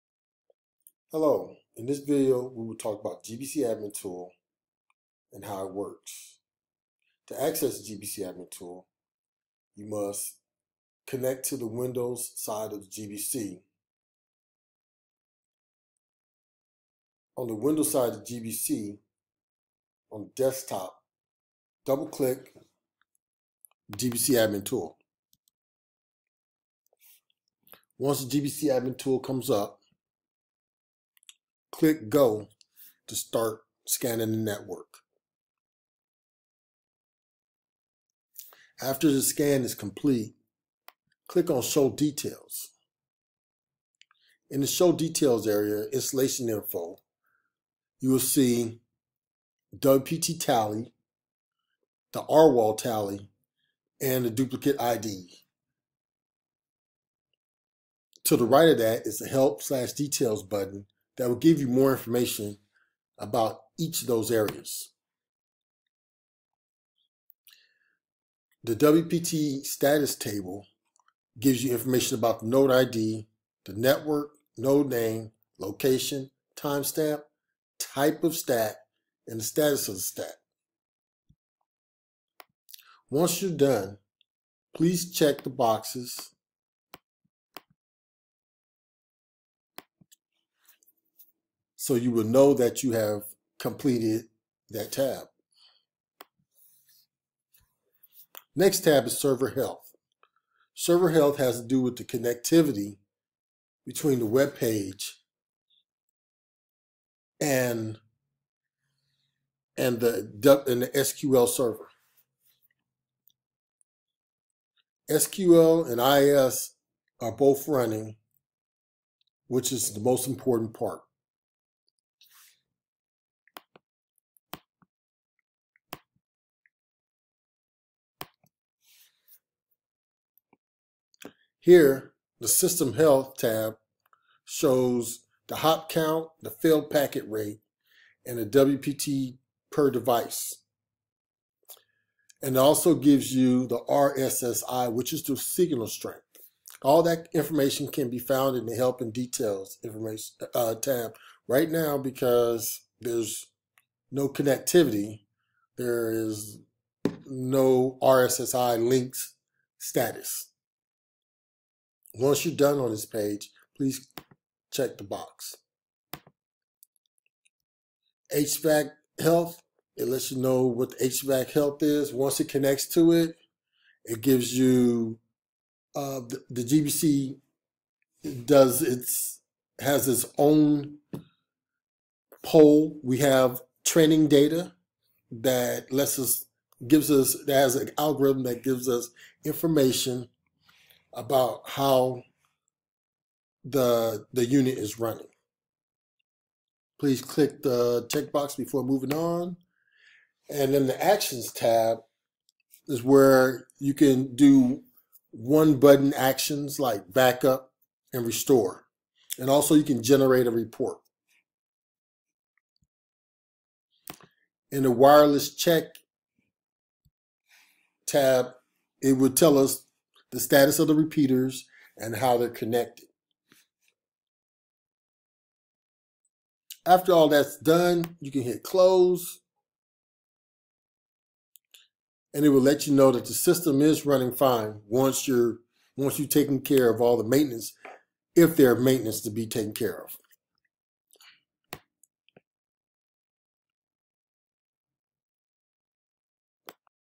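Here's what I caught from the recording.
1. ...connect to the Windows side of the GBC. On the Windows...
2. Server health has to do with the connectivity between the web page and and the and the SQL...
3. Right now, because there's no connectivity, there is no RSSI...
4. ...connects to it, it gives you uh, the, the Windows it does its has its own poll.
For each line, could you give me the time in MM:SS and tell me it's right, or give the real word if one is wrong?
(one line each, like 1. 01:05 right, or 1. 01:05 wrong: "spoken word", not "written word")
1. 00:11 right
2. 01:40 right
3. 02:31 right
4. 02:52 wrong: "GBC", not "Windows".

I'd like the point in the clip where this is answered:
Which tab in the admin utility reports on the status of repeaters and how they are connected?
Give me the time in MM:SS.
03:34.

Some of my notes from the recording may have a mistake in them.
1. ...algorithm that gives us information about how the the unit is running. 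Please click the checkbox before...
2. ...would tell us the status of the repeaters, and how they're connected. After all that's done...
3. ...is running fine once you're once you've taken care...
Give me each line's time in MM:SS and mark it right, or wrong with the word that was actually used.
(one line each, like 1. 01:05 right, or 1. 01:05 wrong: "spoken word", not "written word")
1. 03:07 right
2. 03:39 right
3. 03:53 right.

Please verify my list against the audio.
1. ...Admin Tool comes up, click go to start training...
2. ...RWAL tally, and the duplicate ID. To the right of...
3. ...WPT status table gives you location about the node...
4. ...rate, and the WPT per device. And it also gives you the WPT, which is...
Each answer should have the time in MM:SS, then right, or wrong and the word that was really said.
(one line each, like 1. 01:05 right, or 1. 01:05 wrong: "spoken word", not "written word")
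1. 00:28 wrong: "scanning", not "training"
2. 00:52 right
3. 01:08 wrong: "information", not "location"
4. 02:17 wrong: "RSSI", not "WPT".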